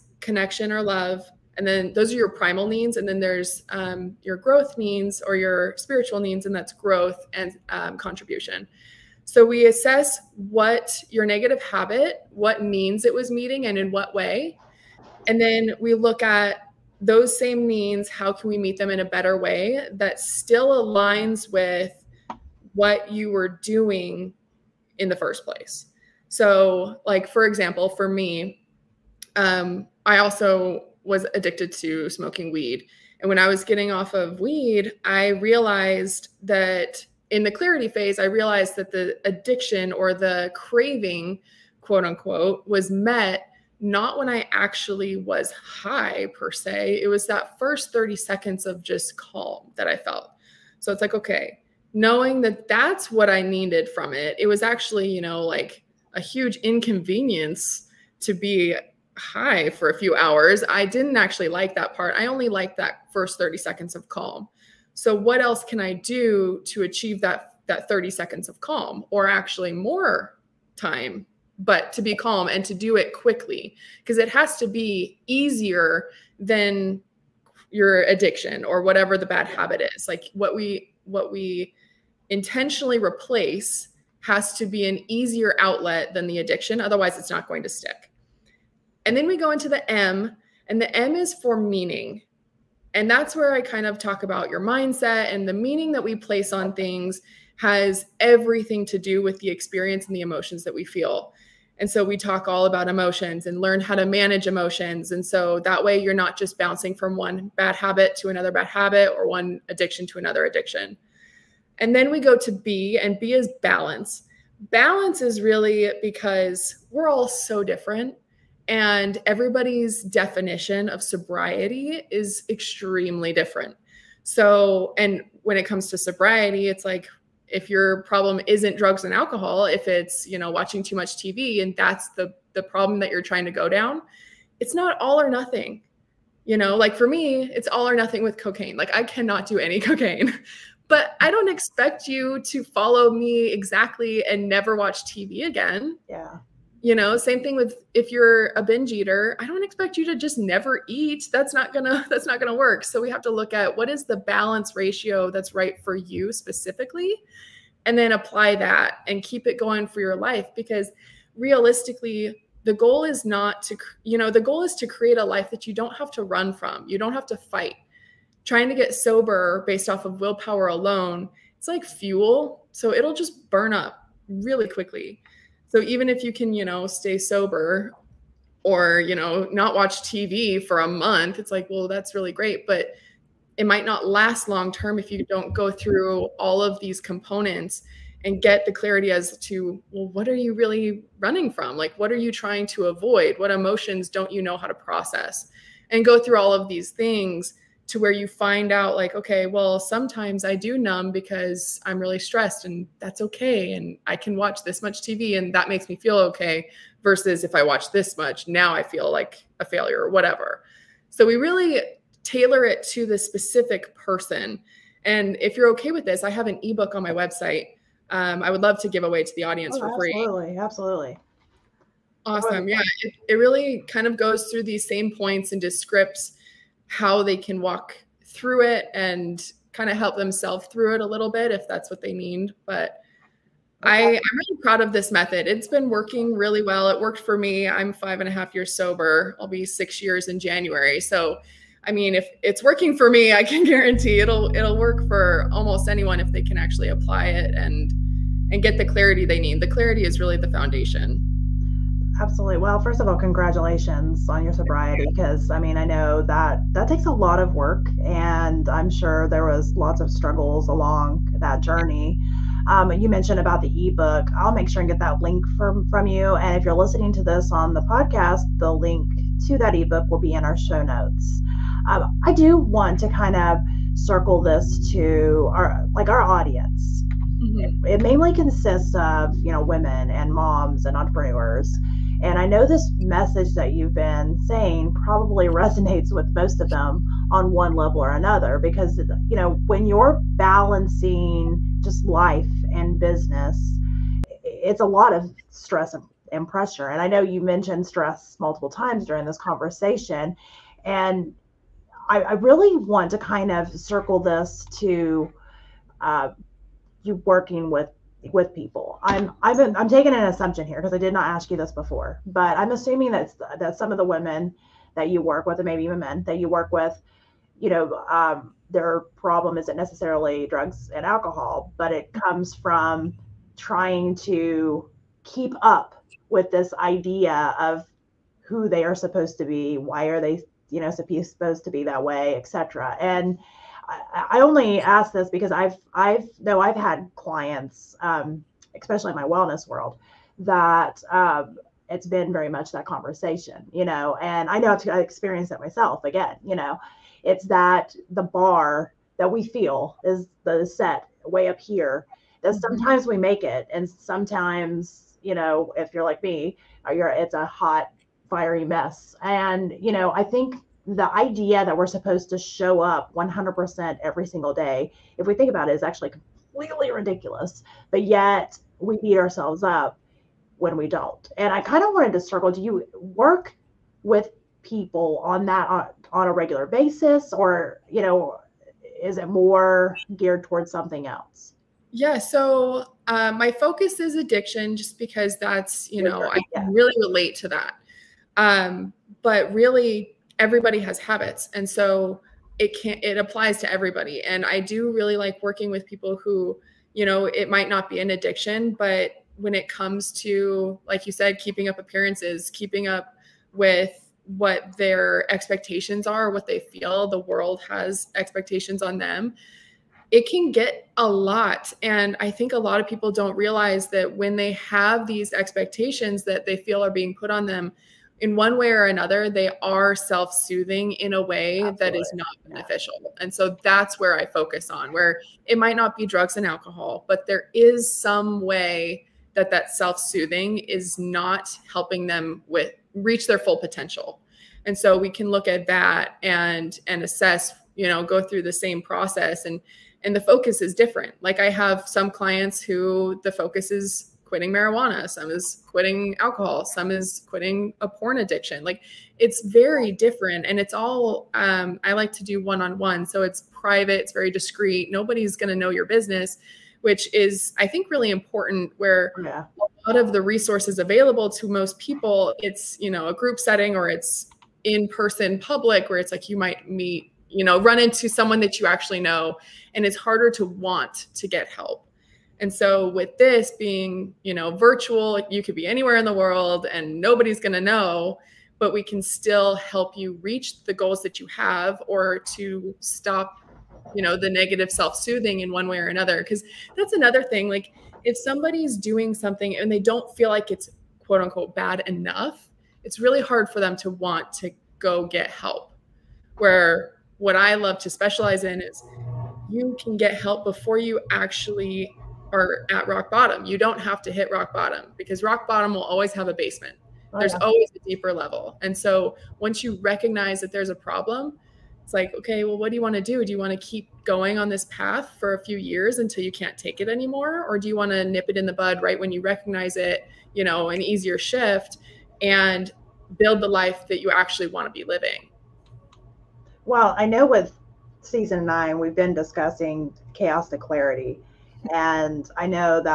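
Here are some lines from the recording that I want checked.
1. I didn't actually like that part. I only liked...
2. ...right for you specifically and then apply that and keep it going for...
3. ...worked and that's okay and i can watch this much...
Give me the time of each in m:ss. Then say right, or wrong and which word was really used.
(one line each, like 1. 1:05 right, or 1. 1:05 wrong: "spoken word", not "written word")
1. 1:00 right
2. 2:35 right
3. 3:22 wrong: "stressed", not "worked".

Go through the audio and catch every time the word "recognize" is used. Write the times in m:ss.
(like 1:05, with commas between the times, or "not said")
8:29, 8:39.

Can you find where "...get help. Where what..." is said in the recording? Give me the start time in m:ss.
8:15.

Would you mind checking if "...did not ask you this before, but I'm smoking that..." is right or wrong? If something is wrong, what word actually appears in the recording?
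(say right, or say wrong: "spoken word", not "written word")
wrong: "assuming", not "smoking".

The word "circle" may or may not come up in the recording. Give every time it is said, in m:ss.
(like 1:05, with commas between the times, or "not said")
4:33, 5:03, 6:12.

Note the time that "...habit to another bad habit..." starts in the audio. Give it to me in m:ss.
1:47.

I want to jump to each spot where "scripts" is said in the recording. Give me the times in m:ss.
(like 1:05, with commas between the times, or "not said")
3:45.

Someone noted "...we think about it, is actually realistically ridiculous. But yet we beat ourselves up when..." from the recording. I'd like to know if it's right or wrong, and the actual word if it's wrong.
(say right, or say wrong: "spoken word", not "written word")
wrong: "completely", not "realistically".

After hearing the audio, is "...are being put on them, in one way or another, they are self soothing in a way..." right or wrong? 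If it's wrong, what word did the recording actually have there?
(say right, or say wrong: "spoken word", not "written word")
right.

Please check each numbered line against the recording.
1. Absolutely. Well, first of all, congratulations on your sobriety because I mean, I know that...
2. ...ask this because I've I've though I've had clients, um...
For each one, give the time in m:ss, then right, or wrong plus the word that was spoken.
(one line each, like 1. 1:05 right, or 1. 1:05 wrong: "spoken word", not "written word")
1. 4:12 right
2. 5:34 right.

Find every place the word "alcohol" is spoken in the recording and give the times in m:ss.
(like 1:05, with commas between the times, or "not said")
2:09, 5:21, 7:06, 7:26.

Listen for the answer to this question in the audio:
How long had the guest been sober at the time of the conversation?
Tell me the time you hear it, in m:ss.
3:57.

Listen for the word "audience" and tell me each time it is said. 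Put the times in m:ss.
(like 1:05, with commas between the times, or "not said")
3:39, 4:36.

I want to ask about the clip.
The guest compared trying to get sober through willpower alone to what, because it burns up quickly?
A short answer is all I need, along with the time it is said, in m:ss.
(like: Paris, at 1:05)
Fuel, at 2:51.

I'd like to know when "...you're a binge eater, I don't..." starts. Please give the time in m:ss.
2:28.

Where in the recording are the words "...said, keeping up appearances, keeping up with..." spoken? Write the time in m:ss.
6:41.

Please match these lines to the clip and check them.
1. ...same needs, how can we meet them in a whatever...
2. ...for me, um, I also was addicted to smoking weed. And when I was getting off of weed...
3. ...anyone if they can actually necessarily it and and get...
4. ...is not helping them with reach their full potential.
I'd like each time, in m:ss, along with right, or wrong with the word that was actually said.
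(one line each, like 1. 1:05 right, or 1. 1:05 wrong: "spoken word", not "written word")
1. 0:17 wrong: "better", not "whatever"
2. 0:27 right
3. 4:05 wrong: "apply", not "necessarily"
4. 7:10 right.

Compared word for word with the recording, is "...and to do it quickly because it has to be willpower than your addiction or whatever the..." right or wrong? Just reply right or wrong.
wrong.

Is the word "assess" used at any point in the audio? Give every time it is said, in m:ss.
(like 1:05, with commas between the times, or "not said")
0:09, 7:17.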